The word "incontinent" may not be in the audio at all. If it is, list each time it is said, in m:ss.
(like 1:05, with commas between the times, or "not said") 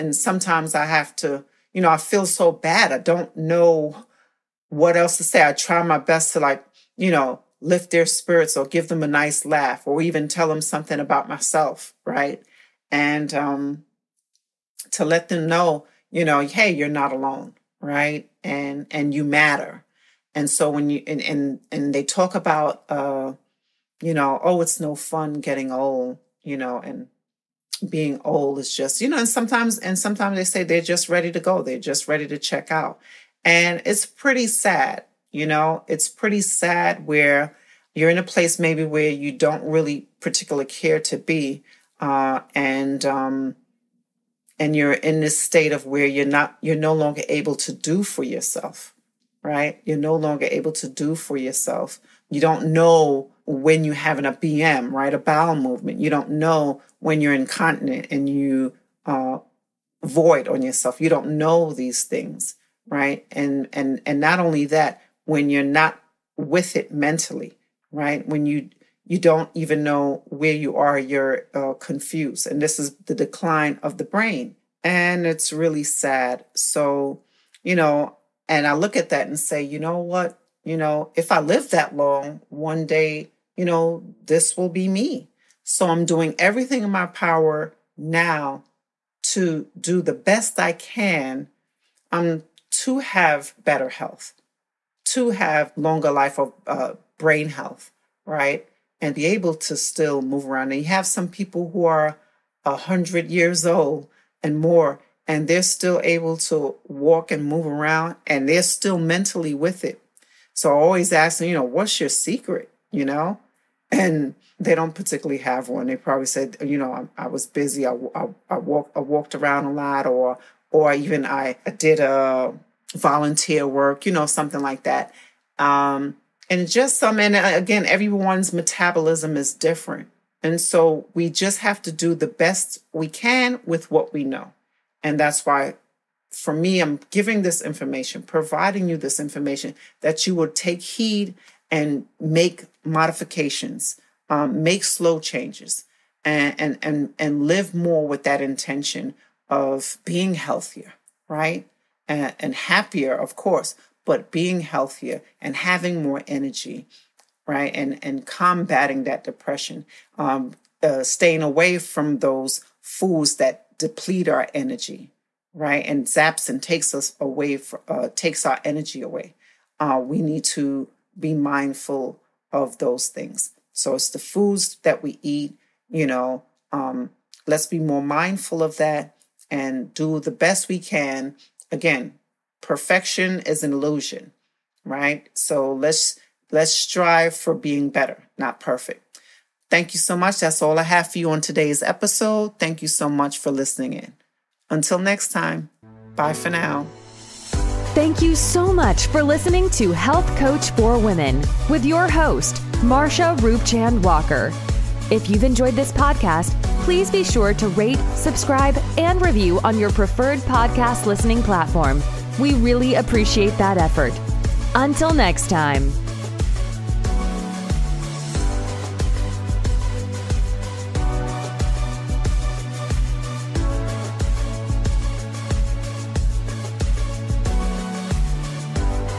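0:57.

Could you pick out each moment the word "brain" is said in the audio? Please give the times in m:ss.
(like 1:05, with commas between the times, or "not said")
1:14, 1:37.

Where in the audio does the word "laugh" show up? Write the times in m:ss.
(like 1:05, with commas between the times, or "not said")
0:09.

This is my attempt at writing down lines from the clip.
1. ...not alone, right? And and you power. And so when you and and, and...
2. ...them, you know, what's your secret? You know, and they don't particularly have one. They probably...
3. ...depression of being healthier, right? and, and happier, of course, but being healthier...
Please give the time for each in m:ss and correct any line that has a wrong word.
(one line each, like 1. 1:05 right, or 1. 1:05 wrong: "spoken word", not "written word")
1. 0:16 wrong: "matter", not "power"
2. 1:51 right
3. 2:28 wrong: "intention", not "depression".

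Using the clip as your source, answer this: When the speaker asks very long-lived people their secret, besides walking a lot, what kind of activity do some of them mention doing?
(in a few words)
volunteer work.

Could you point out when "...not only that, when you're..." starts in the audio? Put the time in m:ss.
1:04.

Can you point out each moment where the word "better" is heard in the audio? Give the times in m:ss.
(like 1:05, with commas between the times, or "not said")
1:33, 3:07.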